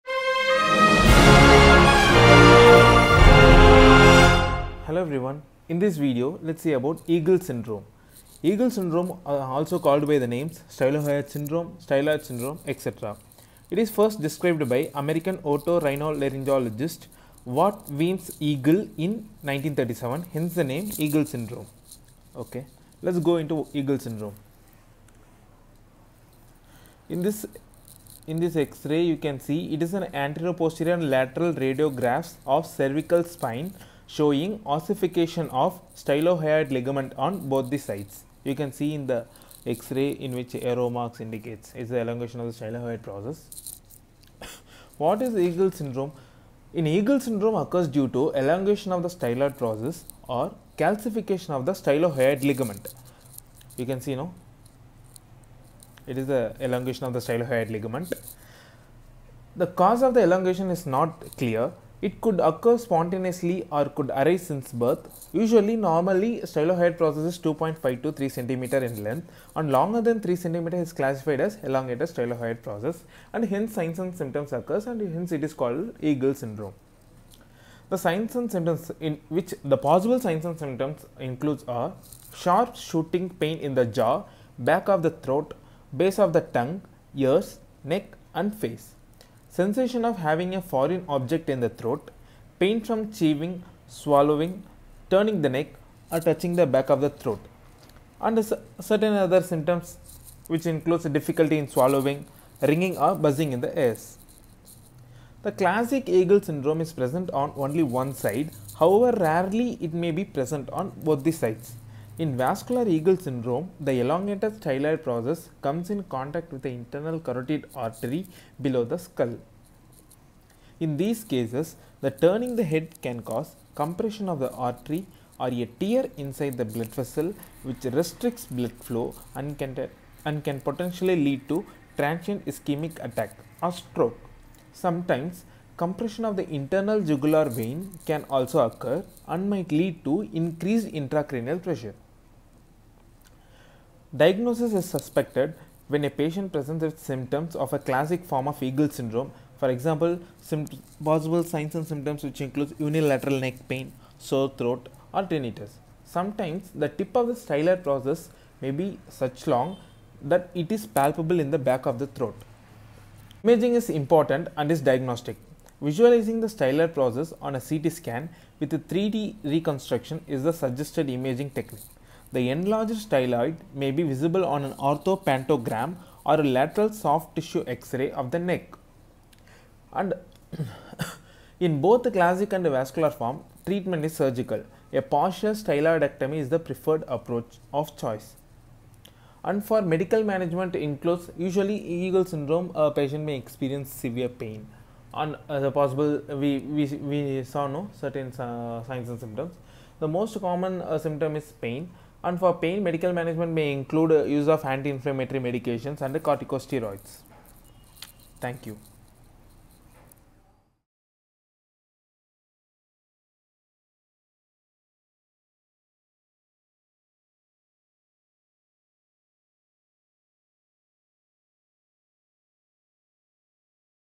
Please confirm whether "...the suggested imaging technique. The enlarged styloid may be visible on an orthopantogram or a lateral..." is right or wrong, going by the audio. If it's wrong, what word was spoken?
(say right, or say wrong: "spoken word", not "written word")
right.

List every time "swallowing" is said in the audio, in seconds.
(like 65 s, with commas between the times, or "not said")
93 s, 101 s.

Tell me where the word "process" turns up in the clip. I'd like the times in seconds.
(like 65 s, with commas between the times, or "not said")
43 s, 49 s, 66 s, 72 s, 115 s, 157 s, 166 s.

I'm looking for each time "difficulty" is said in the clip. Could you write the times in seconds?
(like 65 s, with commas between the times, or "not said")
101 s.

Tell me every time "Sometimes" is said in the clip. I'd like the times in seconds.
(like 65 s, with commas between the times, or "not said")
134 s, 156 s.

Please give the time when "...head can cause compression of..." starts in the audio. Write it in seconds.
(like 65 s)
122 s.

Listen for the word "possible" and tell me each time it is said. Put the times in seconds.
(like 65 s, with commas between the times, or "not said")
79 s, 151 s, 195 s.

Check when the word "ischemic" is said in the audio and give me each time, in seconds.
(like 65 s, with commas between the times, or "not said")
132 s.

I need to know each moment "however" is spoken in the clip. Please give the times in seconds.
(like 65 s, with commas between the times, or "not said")
108 s.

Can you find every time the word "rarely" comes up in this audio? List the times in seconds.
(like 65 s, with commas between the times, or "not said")
109 s.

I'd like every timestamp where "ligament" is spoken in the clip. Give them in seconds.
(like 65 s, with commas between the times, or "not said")
36 s, 52 s, 57 s.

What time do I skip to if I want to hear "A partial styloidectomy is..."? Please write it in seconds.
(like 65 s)
184 s.